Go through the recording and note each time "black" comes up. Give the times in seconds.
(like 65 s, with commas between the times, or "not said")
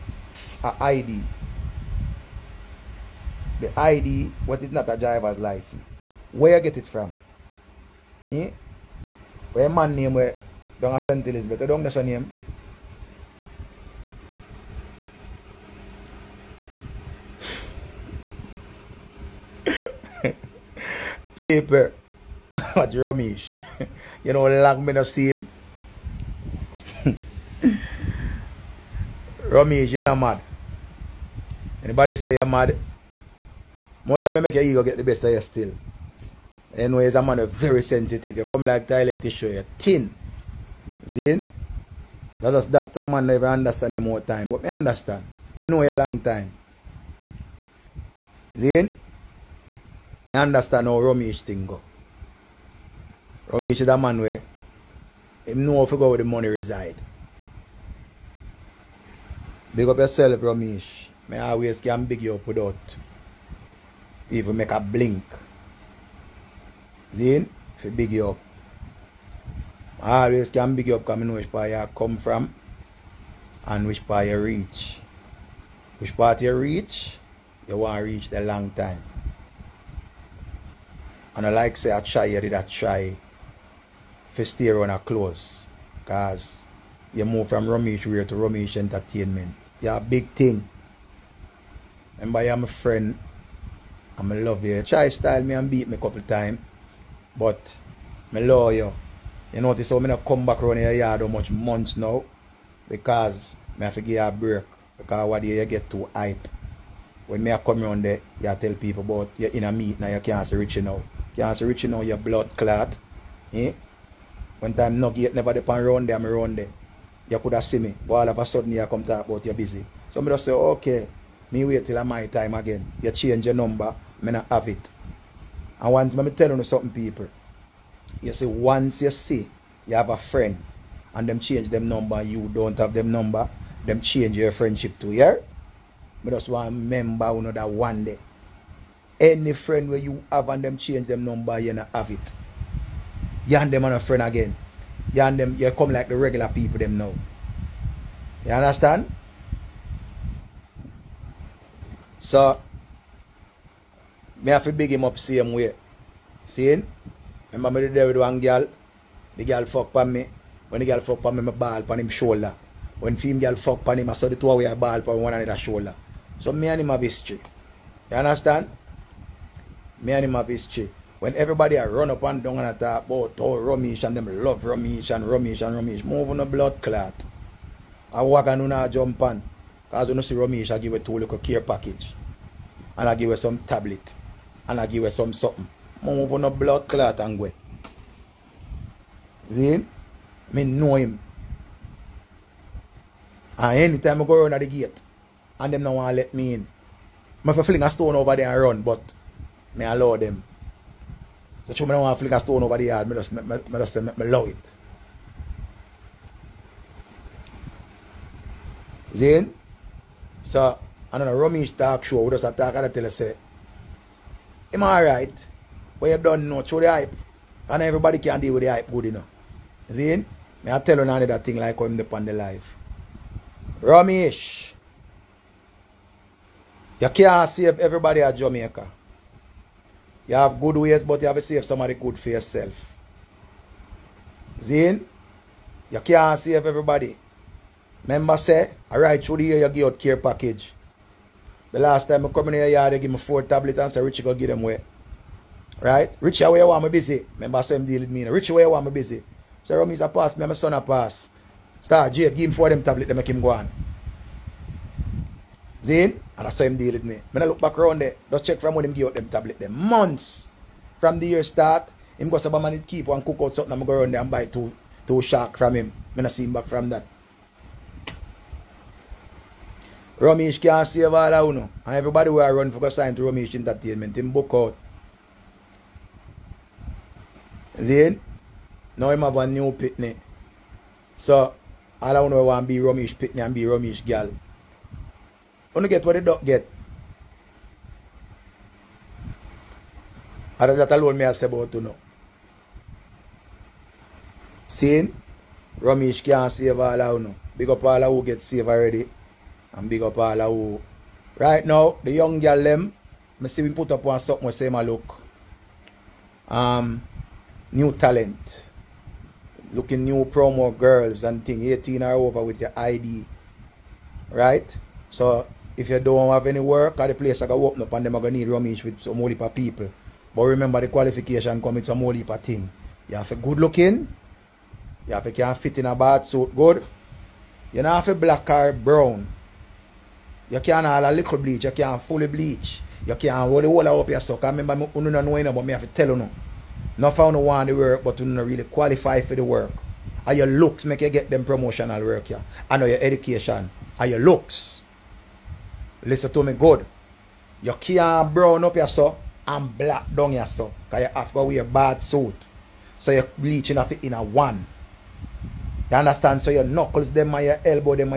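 328 s, 349 s.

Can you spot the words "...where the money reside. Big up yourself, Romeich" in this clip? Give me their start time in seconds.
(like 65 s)
56 s.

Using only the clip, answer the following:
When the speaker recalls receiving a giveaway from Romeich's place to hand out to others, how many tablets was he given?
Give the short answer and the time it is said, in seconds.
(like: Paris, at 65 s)
4, at 243 s.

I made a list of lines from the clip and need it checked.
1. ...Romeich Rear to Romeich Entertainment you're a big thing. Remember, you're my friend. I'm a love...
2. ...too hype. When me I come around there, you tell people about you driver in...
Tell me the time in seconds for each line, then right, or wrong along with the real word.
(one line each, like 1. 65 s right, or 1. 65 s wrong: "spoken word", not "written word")
1. 87 s right
2. 105 s wrong: "inner", not "driver".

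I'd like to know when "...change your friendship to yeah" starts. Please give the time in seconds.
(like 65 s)
133 s.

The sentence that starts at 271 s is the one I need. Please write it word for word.
And everybody where I run for go sign to Romeich Entertainment, him book out.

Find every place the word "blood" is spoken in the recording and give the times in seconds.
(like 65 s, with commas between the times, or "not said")
112 s, 176 s, 186 s.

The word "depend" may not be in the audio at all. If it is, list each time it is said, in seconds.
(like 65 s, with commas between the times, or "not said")
115 s, 221 s.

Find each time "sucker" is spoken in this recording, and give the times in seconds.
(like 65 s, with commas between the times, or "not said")
334 s.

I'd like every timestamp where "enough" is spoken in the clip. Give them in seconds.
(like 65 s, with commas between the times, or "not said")
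219 s.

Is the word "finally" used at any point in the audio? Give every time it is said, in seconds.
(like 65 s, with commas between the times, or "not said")
not said.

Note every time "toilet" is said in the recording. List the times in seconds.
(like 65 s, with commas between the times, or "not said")
38 s.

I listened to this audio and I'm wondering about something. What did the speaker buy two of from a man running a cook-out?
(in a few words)
shark.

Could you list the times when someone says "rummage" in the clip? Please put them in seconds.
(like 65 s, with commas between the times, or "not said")
211 s, 318 s.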